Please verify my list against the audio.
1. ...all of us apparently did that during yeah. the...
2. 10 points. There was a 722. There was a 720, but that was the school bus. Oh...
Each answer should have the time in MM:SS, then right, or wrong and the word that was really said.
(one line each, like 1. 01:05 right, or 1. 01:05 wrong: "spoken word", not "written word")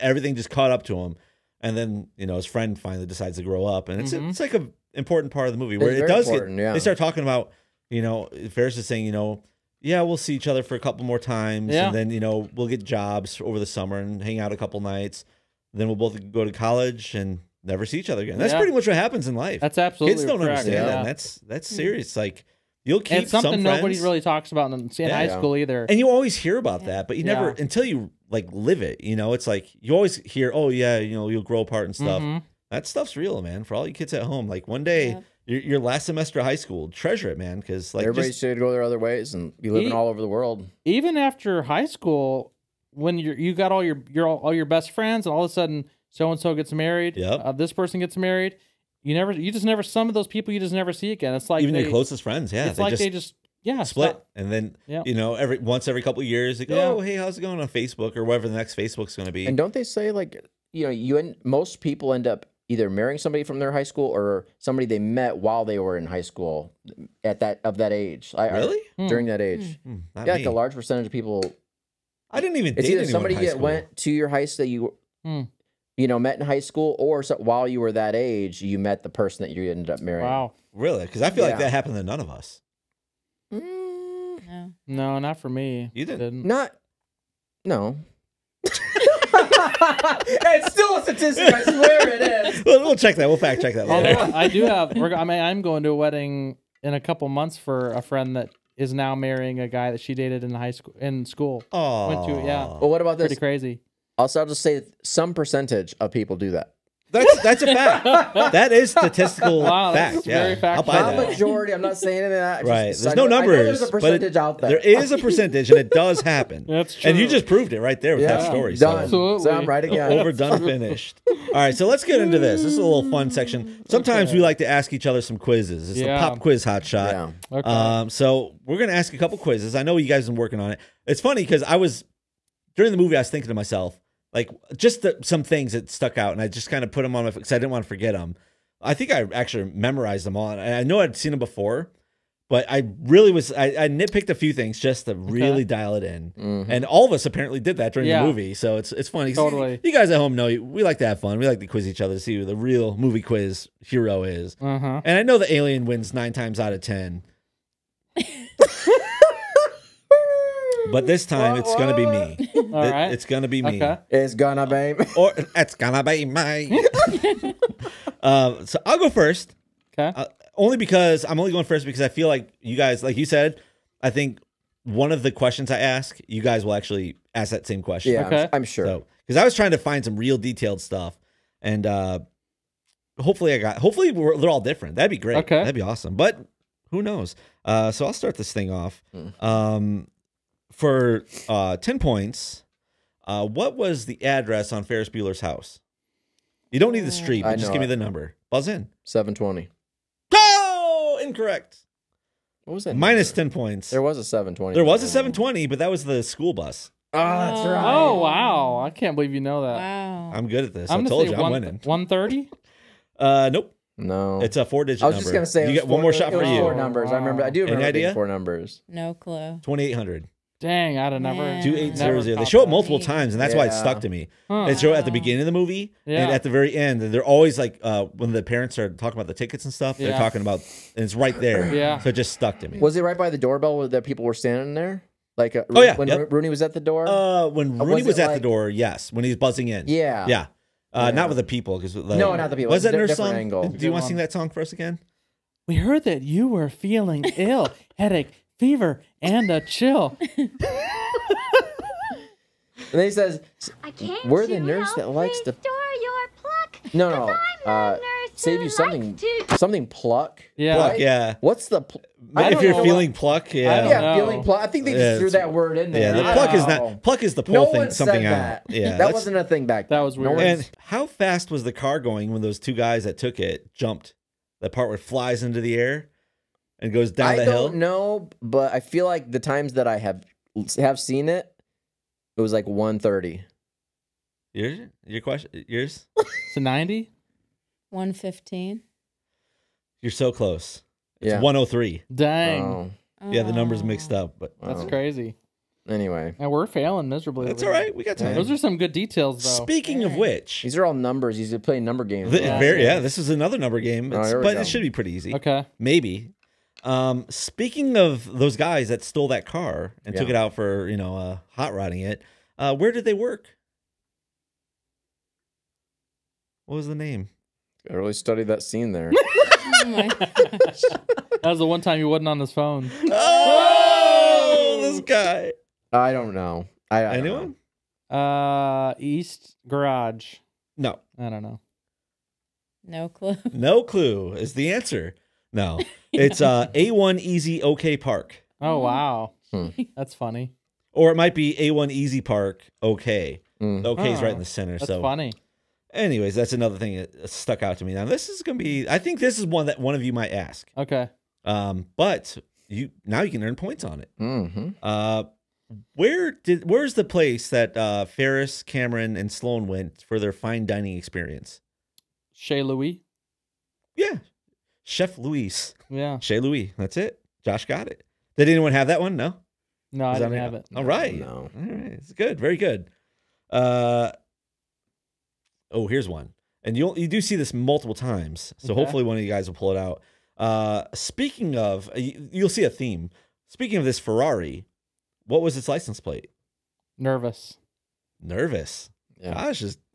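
1. 02:26 right
2. 03:23 wrong: "720", not "722".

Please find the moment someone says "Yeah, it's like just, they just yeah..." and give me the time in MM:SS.
00:52.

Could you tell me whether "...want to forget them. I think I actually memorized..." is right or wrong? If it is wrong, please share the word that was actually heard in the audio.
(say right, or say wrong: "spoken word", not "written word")
right.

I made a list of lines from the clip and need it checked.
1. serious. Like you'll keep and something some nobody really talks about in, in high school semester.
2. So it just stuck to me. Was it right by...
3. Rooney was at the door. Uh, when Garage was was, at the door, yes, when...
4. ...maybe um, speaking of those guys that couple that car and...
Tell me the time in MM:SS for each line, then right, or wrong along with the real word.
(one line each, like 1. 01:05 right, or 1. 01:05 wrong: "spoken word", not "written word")
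1. 00:21 wrong: "either", not "semester"
2. 03:51 right
3. 03:56 wrong: "Rooney", not "Garage"
4. 05:05 wrong: "stole", not "couple".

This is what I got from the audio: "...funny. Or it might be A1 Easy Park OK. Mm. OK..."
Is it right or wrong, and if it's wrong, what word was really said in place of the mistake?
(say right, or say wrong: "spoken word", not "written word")
right.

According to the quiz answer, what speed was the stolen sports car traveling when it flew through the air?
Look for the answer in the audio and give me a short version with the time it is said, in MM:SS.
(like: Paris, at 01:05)
103, at 04:51.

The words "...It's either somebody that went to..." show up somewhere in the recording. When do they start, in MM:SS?
01:12.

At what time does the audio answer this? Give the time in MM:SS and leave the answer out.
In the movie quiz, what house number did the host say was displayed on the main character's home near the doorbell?
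03:39.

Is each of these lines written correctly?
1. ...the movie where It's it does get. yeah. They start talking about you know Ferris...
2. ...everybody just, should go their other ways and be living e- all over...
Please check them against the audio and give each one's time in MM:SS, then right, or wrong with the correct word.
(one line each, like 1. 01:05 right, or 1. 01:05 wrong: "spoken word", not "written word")
1. 00:05 right
2. 00:38 right.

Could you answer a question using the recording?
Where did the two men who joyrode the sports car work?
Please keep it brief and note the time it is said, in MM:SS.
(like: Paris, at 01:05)
A1 Easy OK Park, at 05:36.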